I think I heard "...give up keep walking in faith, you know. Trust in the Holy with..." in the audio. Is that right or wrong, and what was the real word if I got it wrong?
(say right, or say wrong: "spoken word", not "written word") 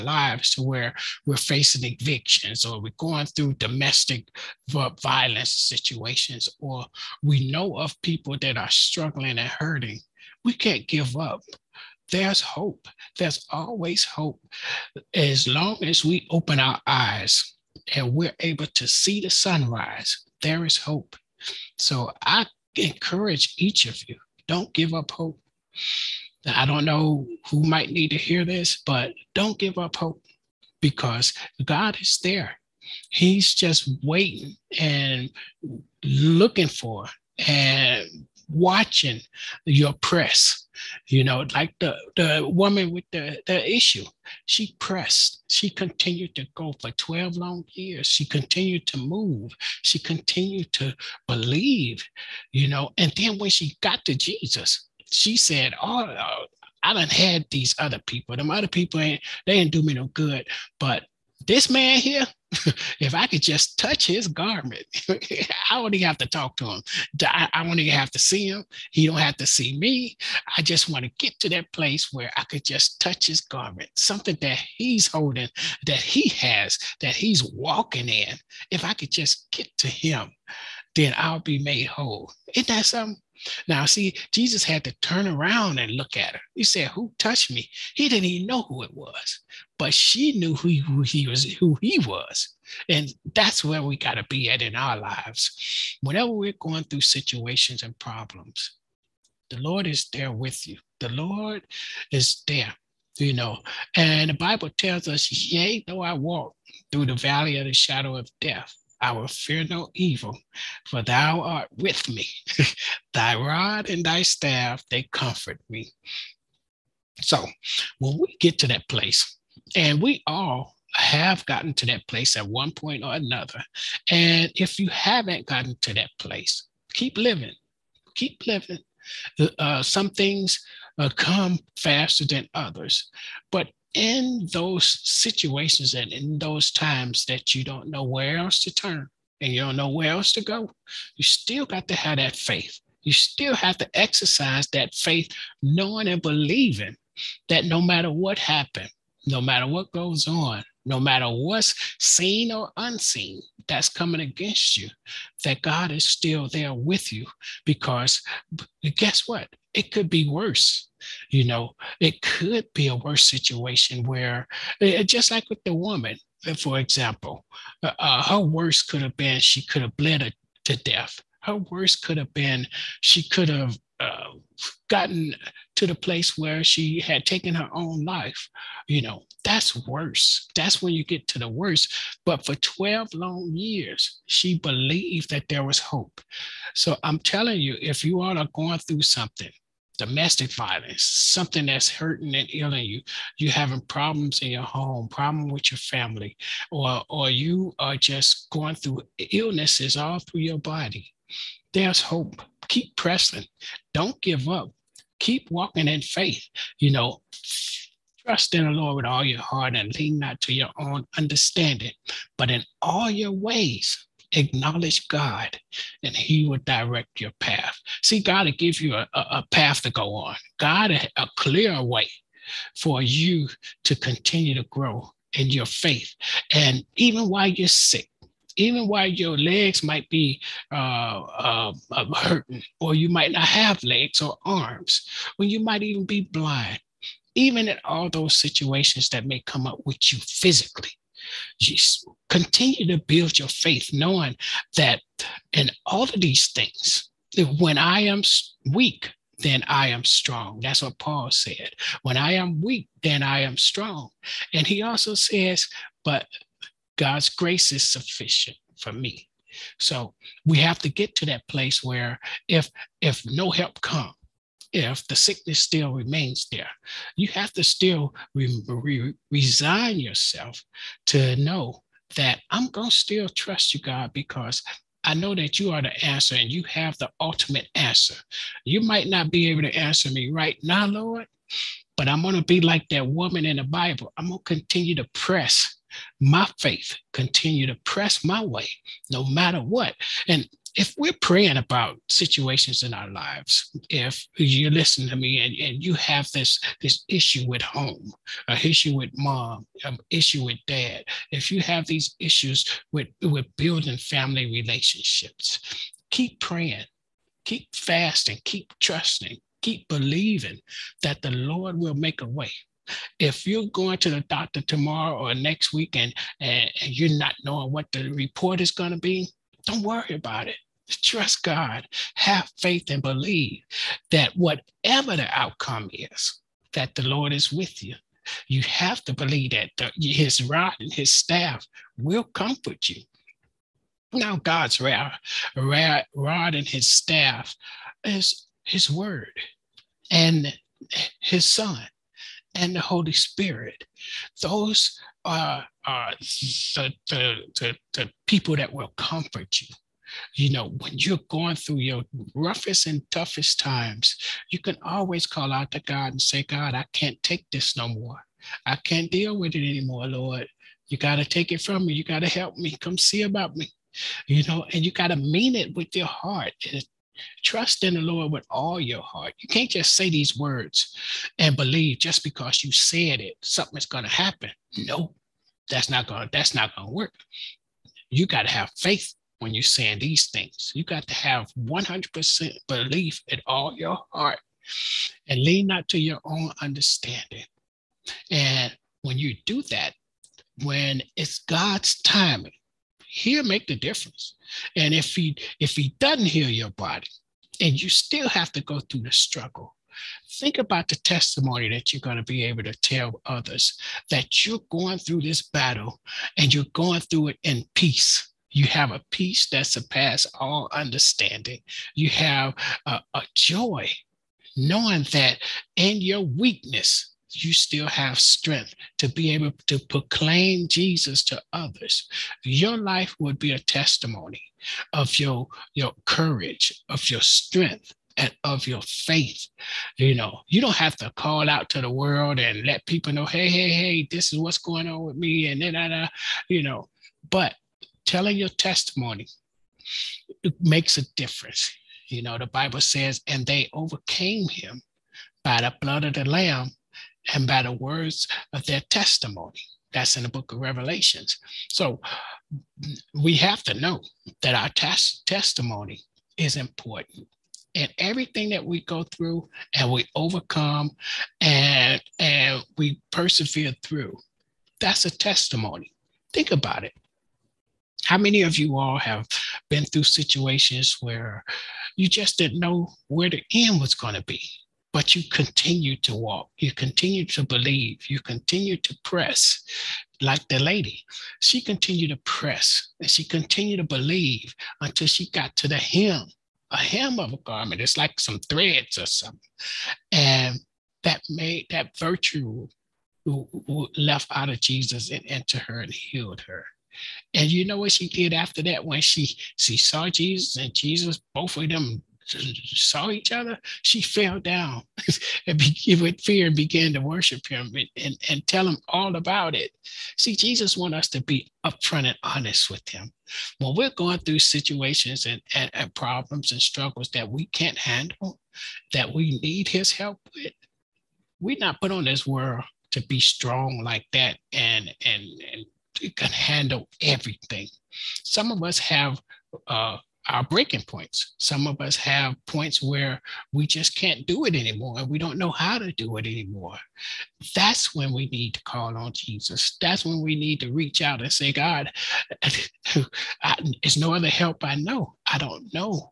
wrong: "Lord", not "Holy".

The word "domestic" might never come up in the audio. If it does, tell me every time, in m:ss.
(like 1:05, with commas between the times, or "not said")
0:03, 3:09.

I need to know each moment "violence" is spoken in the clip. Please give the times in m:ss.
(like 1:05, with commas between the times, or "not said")
0:05, 3:10.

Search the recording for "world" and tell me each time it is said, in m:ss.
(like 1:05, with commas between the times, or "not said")
7:11, 8:42.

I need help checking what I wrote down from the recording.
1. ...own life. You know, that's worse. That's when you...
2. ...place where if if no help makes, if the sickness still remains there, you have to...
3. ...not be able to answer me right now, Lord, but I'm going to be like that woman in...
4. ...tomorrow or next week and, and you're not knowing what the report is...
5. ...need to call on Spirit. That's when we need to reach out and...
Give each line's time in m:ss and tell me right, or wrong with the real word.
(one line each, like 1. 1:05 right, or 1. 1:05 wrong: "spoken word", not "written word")
1. 2:57 right
2. 4:21 wrong: "comes", not "makes"
3. 4:39 right
4. 5:14 right
5. 8:58 wrong: "Jesus", not "Spirit".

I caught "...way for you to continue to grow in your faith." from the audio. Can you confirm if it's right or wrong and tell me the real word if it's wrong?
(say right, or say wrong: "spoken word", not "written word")
right.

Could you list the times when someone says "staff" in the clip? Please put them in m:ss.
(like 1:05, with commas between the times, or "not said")
1:54, 5:31, 5:36.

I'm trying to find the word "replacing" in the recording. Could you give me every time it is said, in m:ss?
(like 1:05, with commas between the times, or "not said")
not said.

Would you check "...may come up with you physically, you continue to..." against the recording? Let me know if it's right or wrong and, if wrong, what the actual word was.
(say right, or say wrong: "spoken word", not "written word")
right.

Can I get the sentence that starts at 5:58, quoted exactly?
I can't deal with it anymore, Lord.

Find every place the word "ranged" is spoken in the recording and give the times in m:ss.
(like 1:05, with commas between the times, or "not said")
not said.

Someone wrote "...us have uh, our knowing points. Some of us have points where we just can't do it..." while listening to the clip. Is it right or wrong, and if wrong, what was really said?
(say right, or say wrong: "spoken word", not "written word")
wrong: "breaking", not "knowing".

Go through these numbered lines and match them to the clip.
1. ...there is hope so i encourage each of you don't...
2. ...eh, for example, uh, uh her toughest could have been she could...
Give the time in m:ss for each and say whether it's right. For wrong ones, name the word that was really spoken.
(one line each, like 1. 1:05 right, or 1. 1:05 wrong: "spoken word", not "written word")
1. 0:20 right
2. 2:46 wrong: "worst", not "toughest".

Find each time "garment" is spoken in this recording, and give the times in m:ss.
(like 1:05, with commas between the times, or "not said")
1:04, 1:13, 8:07.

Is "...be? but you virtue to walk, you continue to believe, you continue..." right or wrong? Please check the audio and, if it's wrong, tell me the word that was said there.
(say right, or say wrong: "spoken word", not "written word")
wrong: "continue", not "virtue".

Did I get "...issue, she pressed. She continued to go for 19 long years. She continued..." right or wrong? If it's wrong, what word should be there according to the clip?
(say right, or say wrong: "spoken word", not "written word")
wrong: "12", not "19".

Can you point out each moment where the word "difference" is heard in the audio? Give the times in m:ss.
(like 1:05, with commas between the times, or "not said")
6:33, 7:21.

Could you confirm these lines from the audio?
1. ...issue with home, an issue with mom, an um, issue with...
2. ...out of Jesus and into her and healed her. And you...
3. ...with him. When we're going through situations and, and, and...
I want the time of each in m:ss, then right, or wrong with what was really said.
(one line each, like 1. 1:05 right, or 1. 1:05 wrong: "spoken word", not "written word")
1. 4:57 right
2. 8:14 right
3. 8:32 right.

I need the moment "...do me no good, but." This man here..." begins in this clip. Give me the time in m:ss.
0:59.